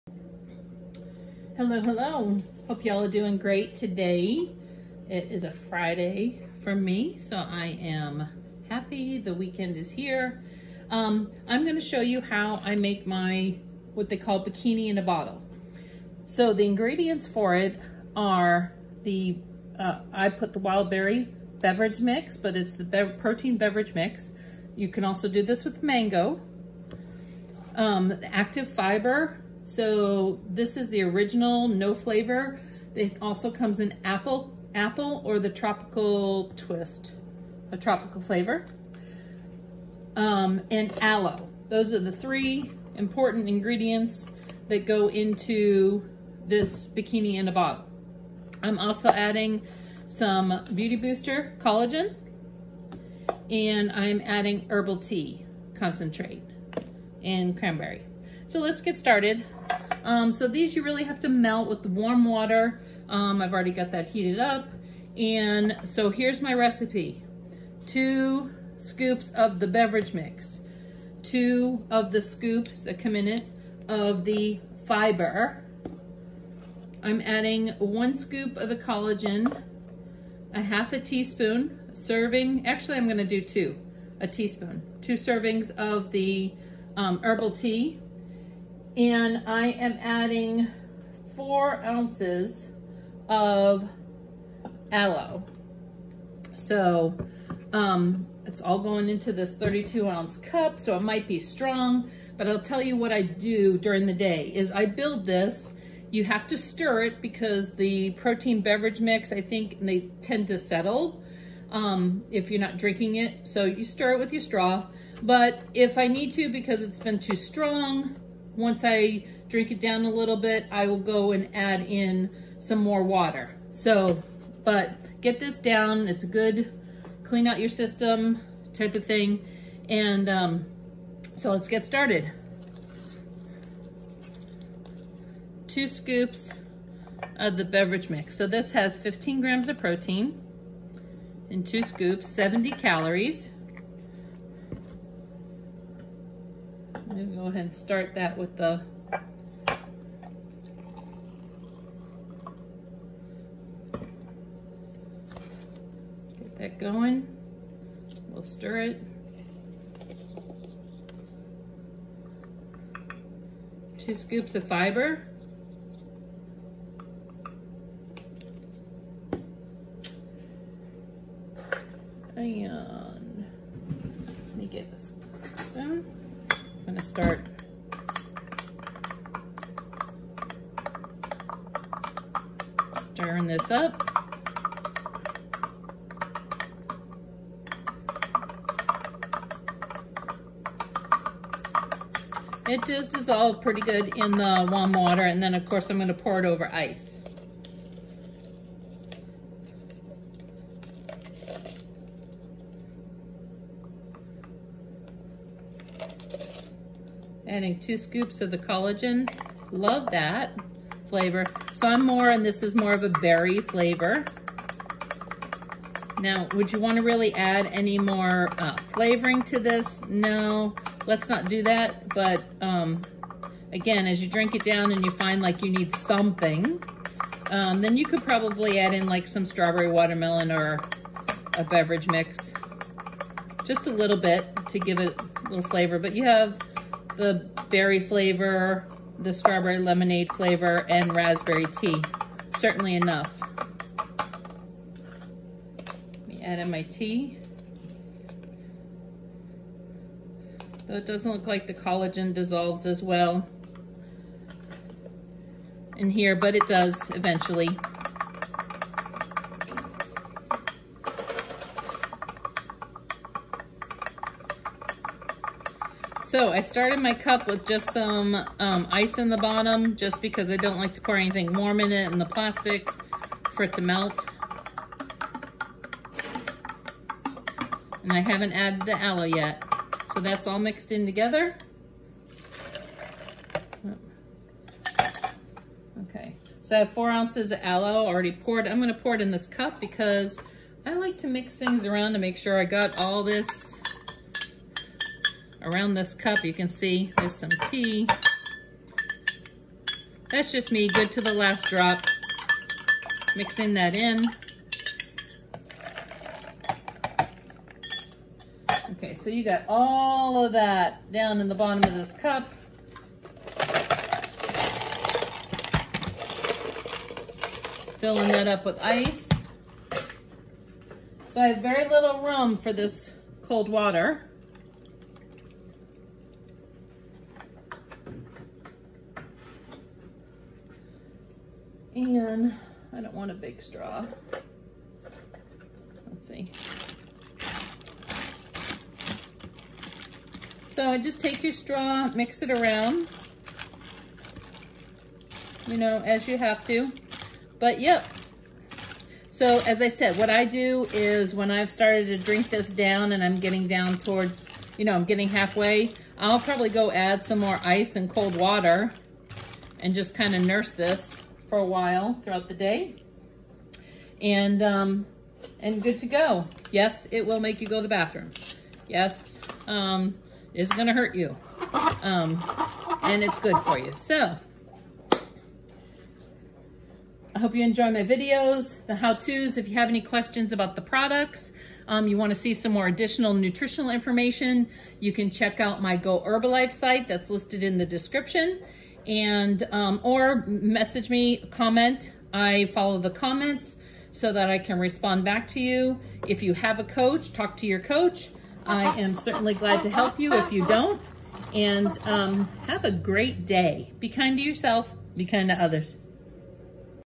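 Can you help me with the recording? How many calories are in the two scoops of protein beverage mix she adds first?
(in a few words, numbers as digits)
70.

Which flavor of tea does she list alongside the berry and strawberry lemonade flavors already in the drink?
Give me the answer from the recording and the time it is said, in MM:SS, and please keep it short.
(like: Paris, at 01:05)
Raspberry, at 04:01.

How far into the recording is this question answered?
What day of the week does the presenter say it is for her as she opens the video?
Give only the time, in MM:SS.
00:05.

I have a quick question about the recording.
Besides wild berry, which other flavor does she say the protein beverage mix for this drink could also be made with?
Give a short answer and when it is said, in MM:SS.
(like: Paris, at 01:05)
Mango, at 00:25.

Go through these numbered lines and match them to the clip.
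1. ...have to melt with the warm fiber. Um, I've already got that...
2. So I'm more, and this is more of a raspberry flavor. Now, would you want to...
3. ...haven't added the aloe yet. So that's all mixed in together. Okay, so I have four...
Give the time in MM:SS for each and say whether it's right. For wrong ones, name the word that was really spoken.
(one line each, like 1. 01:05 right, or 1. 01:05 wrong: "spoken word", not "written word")
1. 01:01 wrong: "water", not "fiber"
2. 03:31 wrong: "berry", not "raspberry"
3. 04:38 right.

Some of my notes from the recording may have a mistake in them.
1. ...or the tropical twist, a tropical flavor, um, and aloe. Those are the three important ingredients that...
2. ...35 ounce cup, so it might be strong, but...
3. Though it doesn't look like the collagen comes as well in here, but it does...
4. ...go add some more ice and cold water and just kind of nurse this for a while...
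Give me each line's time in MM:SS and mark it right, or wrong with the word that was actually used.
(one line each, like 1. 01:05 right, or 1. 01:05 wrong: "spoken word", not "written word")
1. 00:35 right
2. 01:39 wrong: "32", not "35"
3. 04:10 wrong: "dissolves", not "comes"
4. 05:56 right.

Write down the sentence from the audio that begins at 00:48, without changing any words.
I'm also adding some Beauty Booster collagen, and I'm adding herbal tea concentrate and cranberry.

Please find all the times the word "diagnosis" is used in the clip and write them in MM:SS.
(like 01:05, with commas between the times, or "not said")
not said.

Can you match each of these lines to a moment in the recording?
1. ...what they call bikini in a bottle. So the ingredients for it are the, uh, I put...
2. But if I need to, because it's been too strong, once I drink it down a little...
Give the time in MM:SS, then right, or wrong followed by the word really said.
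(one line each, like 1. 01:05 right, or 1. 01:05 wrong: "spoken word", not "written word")
1. 00:13 right
2. 01:55 right.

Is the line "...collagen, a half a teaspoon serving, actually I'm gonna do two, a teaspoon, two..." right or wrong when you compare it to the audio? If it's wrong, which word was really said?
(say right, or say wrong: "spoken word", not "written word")
right.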